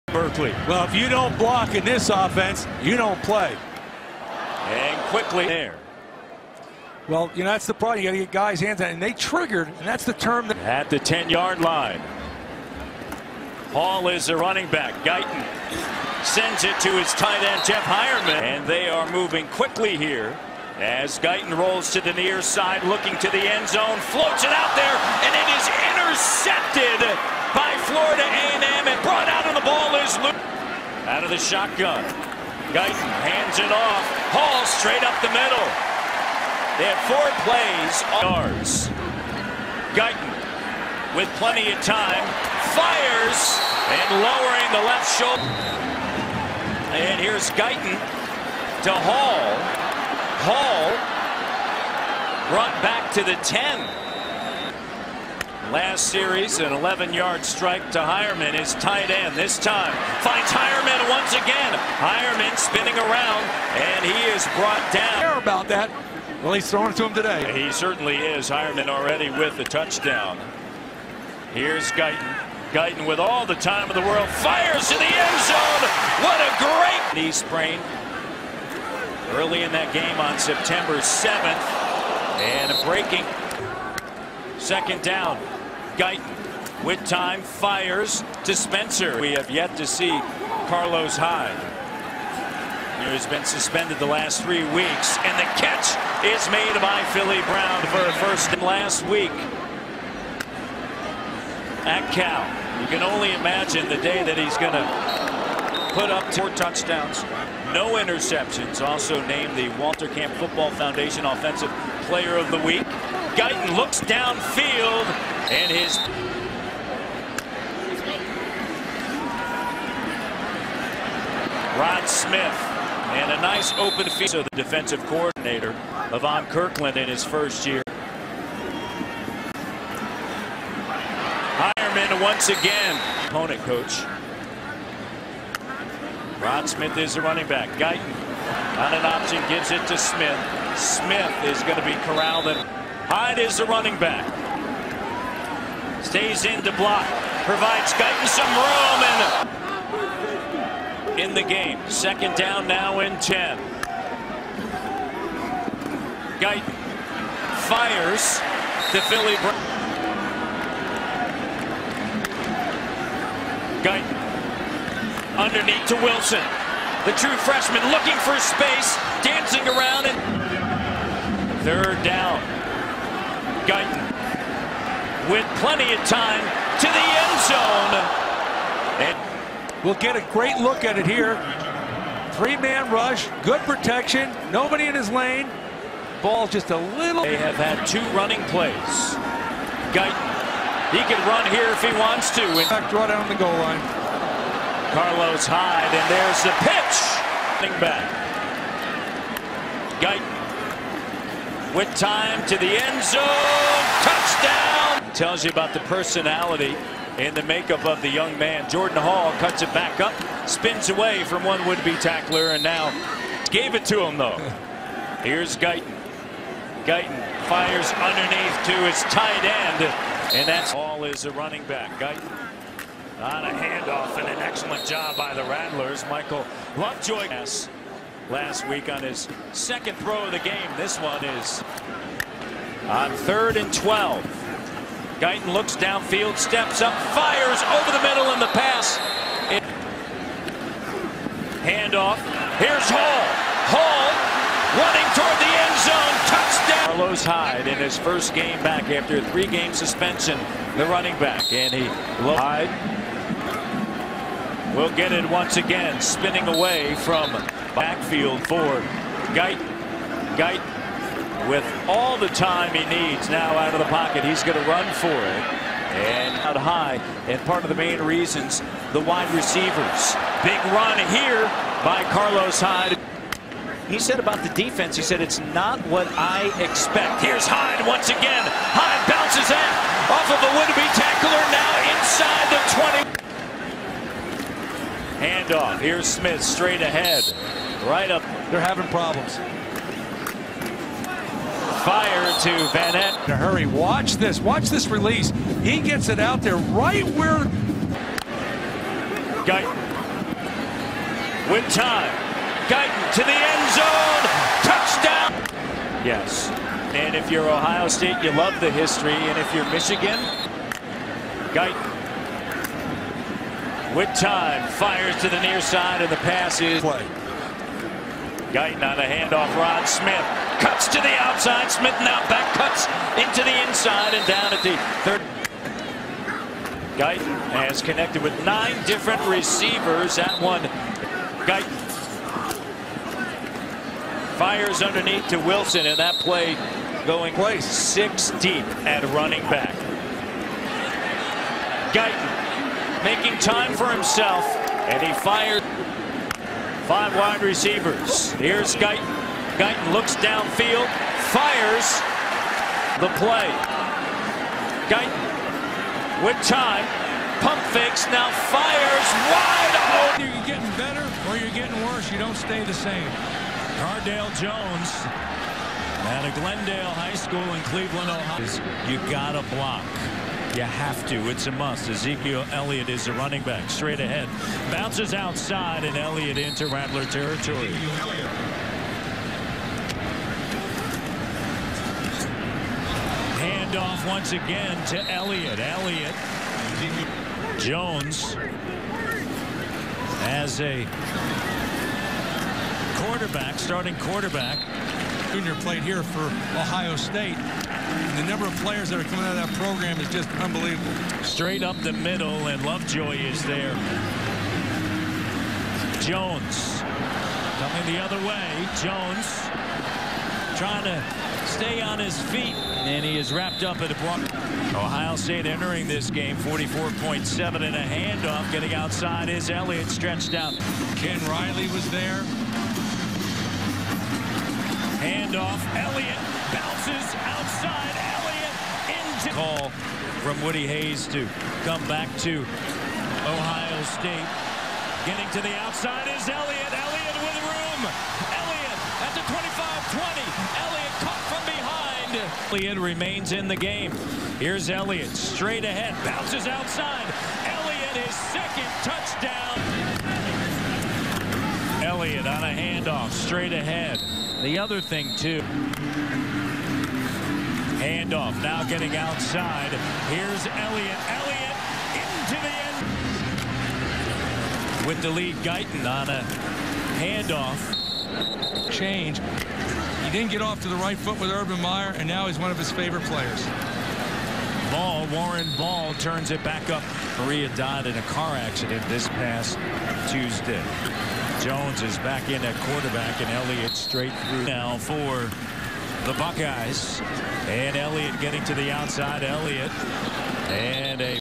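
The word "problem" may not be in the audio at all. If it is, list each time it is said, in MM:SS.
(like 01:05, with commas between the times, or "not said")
00:07, 04:48.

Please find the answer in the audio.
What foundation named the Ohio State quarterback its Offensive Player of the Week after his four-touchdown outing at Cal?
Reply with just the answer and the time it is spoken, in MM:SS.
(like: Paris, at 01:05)
Walter Camp Football Foundation, at 01:49.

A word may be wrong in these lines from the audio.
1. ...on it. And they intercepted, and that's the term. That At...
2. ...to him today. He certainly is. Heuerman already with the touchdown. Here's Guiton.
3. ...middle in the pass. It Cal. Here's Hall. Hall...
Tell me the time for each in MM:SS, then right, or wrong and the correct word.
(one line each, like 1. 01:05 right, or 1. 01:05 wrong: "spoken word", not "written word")
1. 00:08 wrong: "triggered", not "intercepted"
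2. 01:06 right
3. 03:58 wrong: "Handoff", not "Cal".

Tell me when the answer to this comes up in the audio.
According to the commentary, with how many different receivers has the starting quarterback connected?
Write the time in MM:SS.
05:28.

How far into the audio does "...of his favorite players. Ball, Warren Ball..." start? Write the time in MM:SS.
07:52.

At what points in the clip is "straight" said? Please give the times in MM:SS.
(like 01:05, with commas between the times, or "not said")
00:34, 04:46, 06:13, 06:41, 07:25, 07:33, 08:03.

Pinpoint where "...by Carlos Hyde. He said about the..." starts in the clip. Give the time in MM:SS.
04:31.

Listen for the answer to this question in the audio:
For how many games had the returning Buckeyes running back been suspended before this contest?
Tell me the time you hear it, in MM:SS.
04:09.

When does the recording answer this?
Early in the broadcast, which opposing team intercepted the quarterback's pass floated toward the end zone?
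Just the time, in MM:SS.
00:27.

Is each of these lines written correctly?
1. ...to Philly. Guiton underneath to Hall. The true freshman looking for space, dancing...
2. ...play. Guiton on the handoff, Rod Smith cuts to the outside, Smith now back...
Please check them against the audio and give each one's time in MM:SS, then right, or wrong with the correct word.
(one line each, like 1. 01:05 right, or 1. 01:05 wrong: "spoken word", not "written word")
1. 02:38 wrong: "Wilson", not "Hall"
2. 05:16 right.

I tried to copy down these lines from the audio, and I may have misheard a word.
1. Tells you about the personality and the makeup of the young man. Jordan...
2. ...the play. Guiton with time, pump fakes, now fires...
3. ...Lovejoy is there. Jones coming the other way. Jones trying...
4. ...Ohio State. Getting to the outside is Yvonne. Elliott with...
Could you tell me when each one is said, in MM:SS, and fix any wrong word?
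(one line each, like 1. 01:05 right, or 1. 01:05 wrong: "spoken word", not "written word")
1. 03:25 right
2. 05:53 right
3. 06:42 right
4. 07:13 wrong: "Elliott", not "Yvonne".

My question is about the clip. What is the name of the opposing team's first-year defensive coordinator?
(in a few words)
Yvonne Kirkland.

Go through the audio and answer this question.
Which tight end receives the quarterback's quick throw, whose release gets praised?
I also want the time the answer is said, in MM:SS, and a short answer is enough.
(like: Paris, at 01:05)
Vannett, at 04:52.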